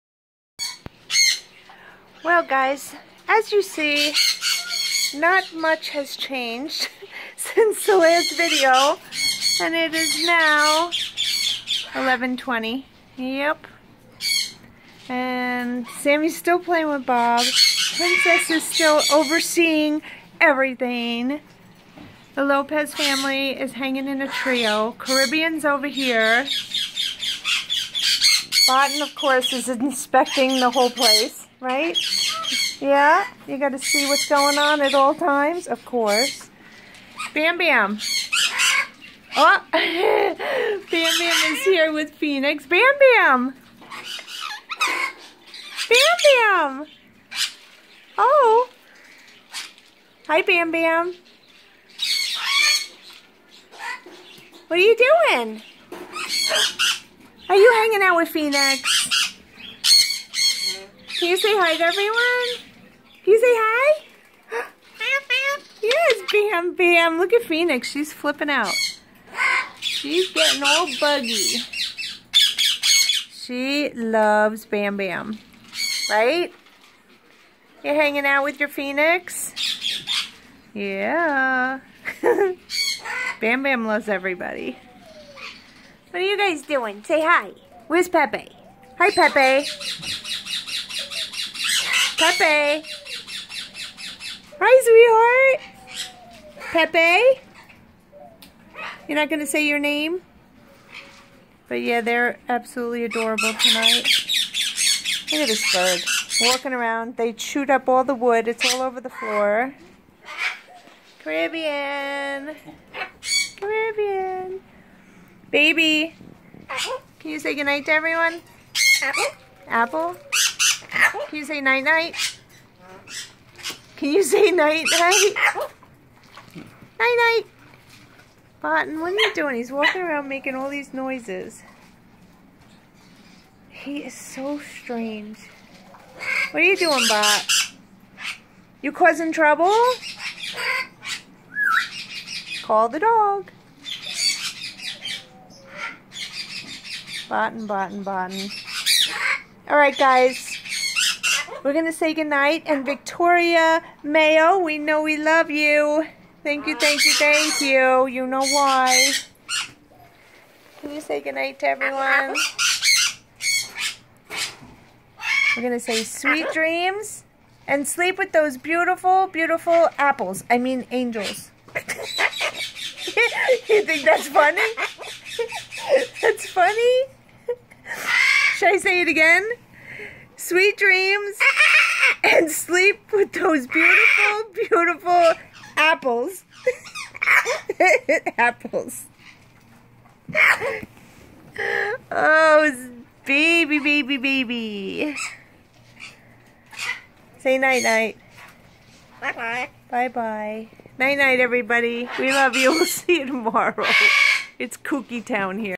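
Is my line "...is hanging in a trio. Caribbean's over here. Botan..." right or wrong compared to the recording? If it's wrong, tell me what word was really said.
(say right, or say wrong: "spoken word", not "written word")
right.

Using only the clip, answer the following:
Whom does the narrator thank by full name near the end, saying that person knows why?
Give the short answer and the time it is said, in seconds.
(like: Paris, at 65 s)
Victoria Mayo, at 152 s.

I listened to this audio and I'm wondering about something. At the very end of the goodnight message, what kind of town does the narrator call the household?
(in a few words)
kooky town.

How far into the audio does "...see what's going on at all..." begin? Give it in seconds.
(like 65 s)
33 s.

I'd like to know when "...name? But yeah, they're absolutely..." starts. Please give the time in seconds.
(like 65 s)
99 s.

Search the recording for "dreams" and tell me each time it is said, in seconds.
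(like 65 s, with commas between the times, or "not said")
166 s, 180 s.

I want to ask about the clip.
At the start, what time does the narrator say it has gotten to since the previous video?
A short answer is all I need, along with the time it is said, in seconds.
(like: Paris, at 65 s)
11:20, at 10 s.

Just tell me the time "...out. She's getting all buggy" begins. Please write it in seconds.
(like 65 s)
68 s.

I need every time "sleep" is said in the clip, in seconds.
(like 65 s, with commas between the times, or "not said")
167 s, 182 s.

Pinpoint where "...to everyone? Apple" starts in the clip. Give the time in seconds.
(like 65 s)
117 s.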